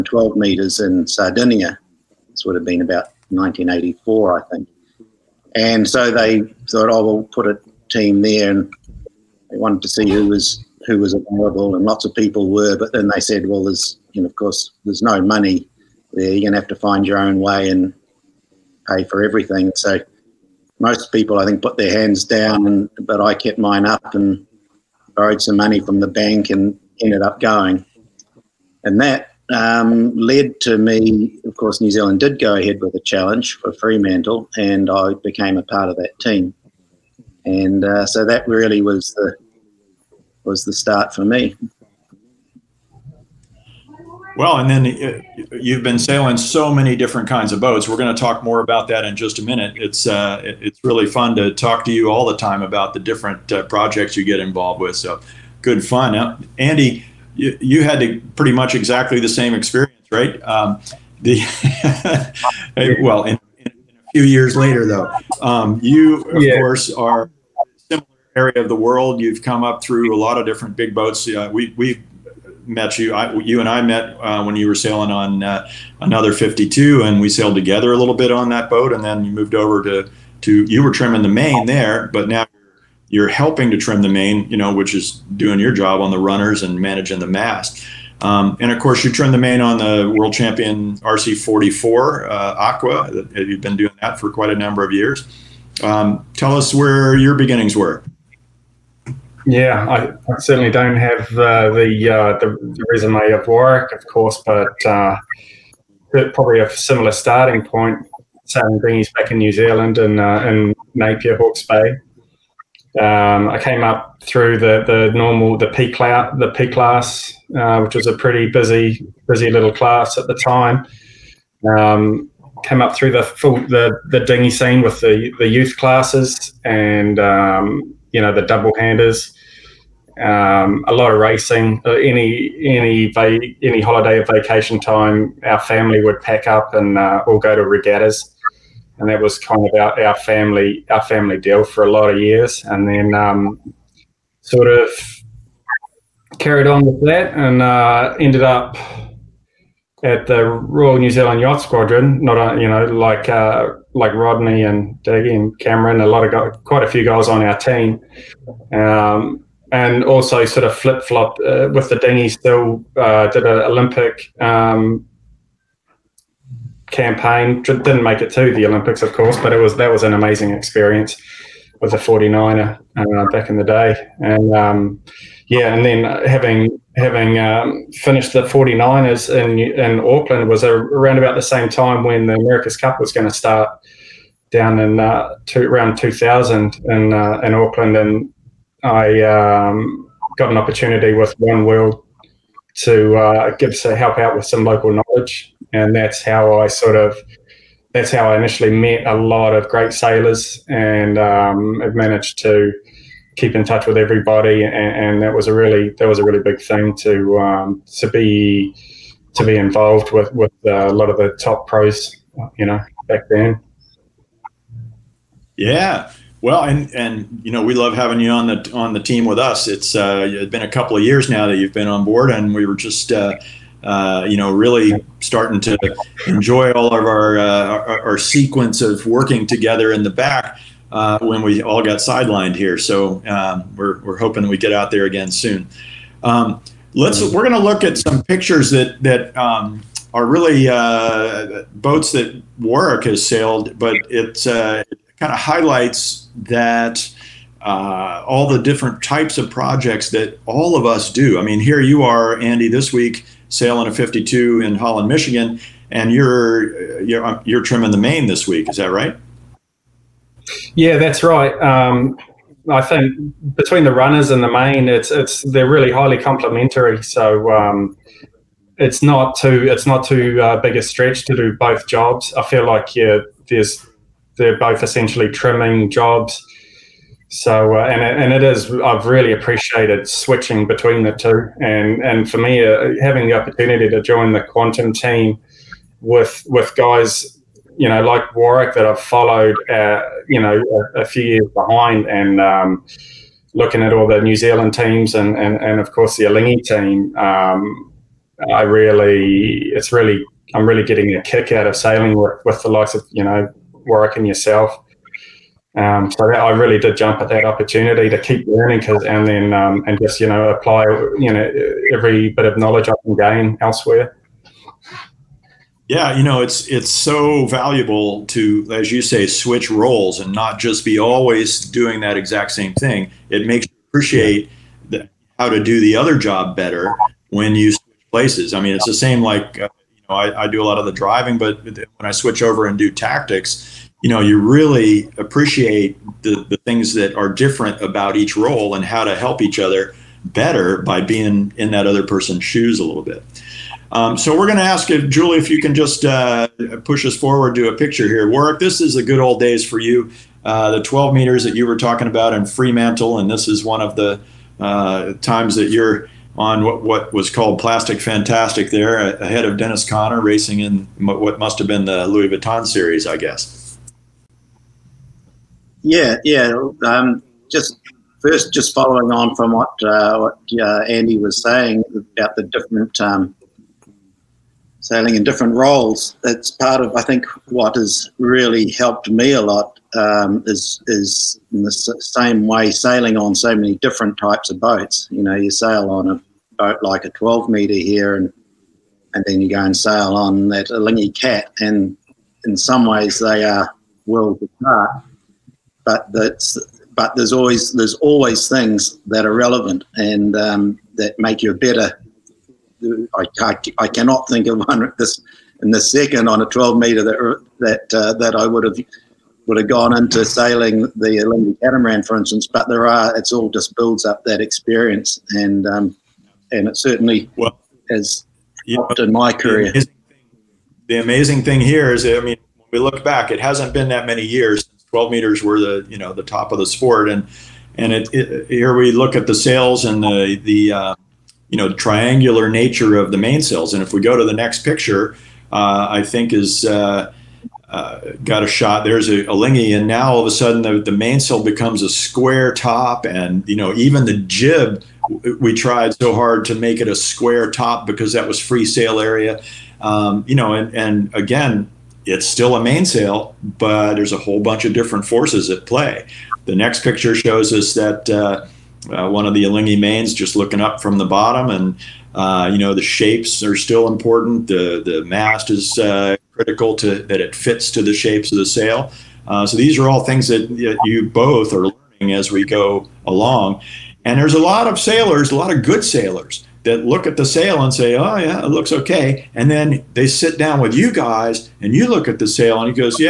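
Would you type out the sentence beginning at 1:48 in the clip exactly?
Sam Greeny's back in New Zealand and uh, in Napier, Hawke's Bay.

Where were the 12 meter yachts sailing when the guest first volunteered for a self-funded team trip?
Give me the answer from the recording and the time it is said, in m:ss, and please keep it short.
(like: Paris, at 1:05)
Sardinia, at 0:01.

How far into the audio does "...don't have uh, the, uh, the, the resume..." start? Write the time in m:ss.
1:40.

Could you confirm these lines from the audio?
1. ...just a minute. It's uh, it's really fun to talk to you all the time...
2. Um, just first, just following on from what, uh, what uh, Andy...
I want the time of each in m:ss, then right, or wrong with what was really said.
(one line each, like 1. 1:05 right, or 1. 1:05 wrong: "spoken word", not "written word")
1. 0:49 right
2. 6:06 right.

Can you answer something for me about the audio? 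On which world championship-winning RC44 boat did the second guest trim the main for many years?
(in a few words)
Aqua.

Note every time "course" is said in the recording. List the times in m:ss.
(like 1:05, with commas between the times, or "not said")
0:14, 0:31, 1:06, 1:28, 1:44, 2:49, 4:55.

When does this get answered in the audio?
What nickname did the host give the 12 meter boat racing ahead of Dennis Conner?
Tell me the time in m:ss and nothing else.
5:57.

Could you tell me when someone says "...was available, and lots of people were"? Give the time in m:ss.
0:10.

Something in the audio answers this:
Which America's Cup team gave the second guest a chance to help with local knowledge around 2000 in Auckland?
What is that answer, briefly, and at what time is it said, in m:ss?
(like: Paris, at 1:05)
One World, at 3:11.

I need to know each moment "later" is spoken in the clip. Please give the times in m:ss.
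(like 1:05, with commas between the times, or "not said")
1:04.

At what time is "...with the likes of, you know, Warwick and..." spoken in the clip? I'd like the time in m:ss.
5:02.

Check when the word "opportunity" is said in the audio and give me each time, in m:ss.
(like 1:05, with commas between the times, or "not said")
3:10, 4:43, 5:07.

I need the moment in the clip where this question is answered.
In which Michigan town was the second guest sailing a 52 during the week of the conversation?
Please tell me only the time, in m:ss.
4:14.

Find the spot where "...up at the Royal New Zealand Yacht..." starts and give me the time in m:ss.
2:28.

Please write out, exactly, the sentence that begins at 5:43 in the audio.
Um, so we're going to ask if Julie, if you can just uh, push us forward to a picture here.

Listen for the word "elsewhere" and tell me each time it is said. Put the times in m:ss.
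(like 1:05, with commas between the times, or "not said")
5:13.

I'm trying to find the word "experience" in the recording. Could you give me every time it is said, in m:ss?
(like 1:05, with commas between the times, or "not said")
0:59, 2:50, 6:54.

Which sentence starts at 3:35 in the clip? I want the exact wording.
Yeah, well, and and you know we love having you on the on the team with us.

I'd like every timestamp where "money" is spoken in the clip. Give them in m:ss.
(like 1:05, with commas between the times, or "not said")
0:15, 0:25.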